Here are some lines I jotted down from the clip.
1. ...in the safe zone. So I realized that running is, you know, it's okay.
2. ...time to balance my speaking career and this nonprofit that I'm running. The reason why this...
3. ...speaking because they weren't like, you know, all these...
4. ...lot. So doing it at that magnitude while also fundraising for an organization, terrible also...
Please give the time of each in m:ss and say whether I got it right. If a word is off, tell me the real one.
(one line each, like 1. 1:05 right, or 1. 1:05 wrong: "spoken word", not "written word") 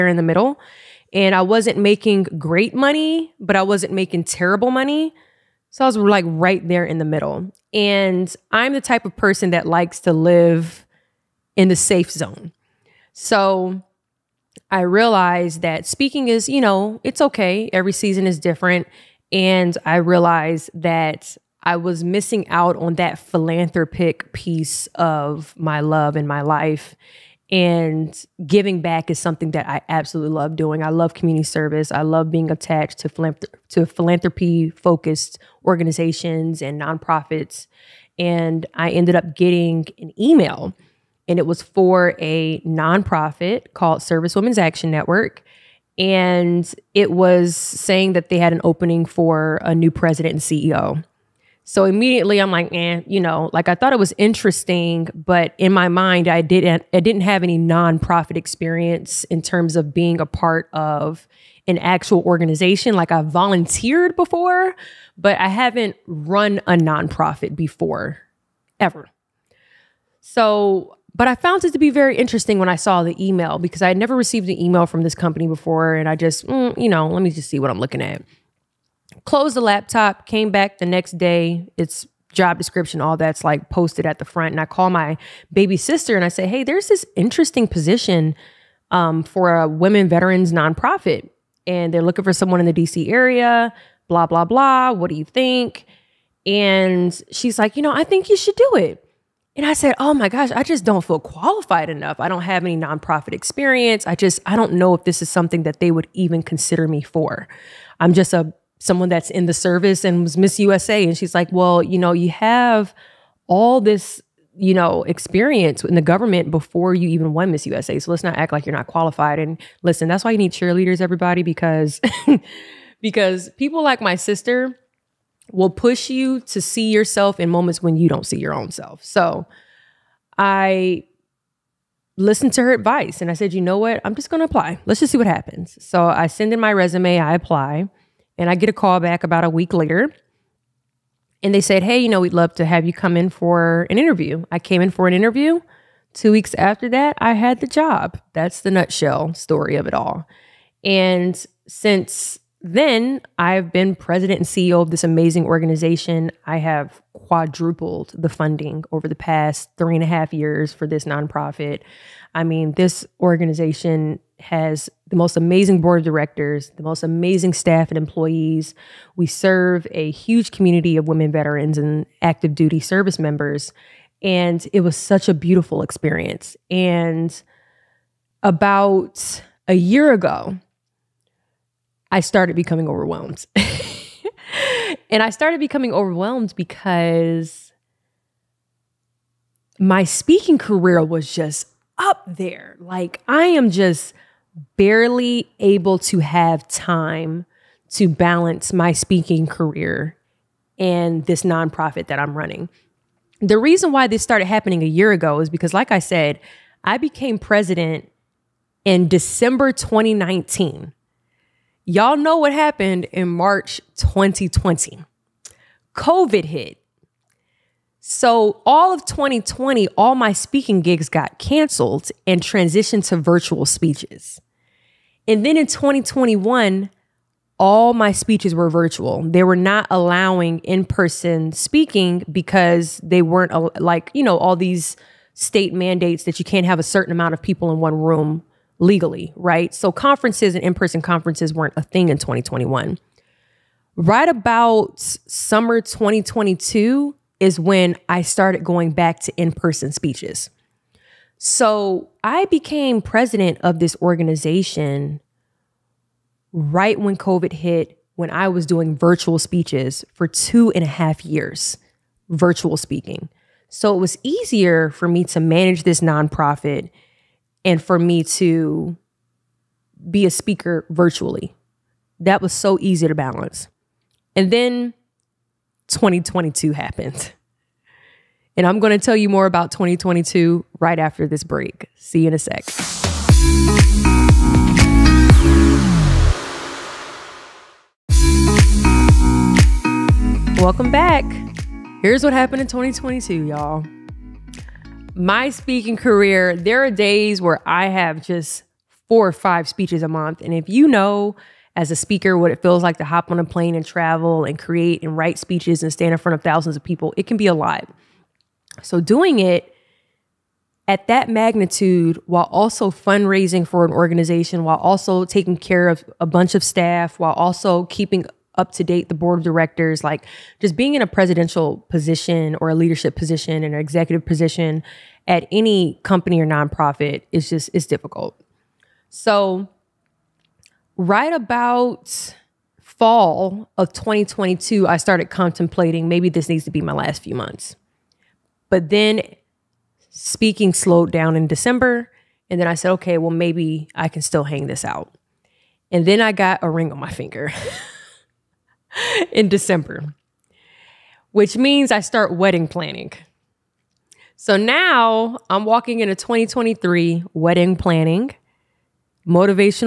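1. 0:11 wrong: "speaking", not "running"
2. 3:16 right
3. 3:51 right
4. 5:07 wrong: "while", not "terrible".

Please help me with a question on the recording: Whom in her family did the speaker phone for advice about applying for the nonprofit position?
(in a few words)
Baby sister.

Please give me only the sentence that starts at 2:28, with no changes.
That's the nutshell story of it all.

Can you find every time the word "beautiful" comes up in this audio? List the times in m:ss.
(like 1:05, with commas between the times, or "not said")
2:55.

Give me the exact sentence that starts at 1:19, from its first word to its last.
Closed the laptop, came back the next day.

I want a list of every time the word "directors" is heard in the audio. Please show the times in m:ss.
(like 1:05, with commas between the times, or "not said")
2:46, 5:19.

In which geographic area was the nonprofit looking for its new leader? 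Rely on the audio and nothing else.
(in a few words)
DC.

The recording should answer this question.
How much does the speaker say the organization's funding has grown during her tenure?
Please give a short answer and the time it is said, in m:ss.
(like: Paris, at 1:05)
Quadrupled, at 2:37.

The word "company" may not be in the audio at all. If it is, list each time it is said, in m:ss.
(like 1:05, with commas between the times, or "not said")
1:15, 5:26.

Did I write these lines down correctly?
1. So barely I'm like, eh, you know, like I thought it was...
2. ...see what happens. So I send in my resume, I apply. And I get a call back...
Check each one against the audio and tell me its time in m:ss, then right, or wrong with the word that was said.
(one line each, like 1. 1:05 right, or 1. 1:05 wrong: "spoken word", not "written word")
1. 0:51 wrong: "immediately", not "barely"
2. 2:15 right.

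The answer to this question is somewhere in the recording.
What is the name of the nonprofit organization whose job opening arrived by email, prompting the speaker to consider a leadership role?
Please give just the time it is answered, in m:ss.
0:44.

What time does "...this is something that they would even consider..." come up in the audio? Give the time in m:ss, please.
1:45.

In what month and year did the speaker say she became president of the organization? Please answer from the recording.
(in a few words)
December 2019.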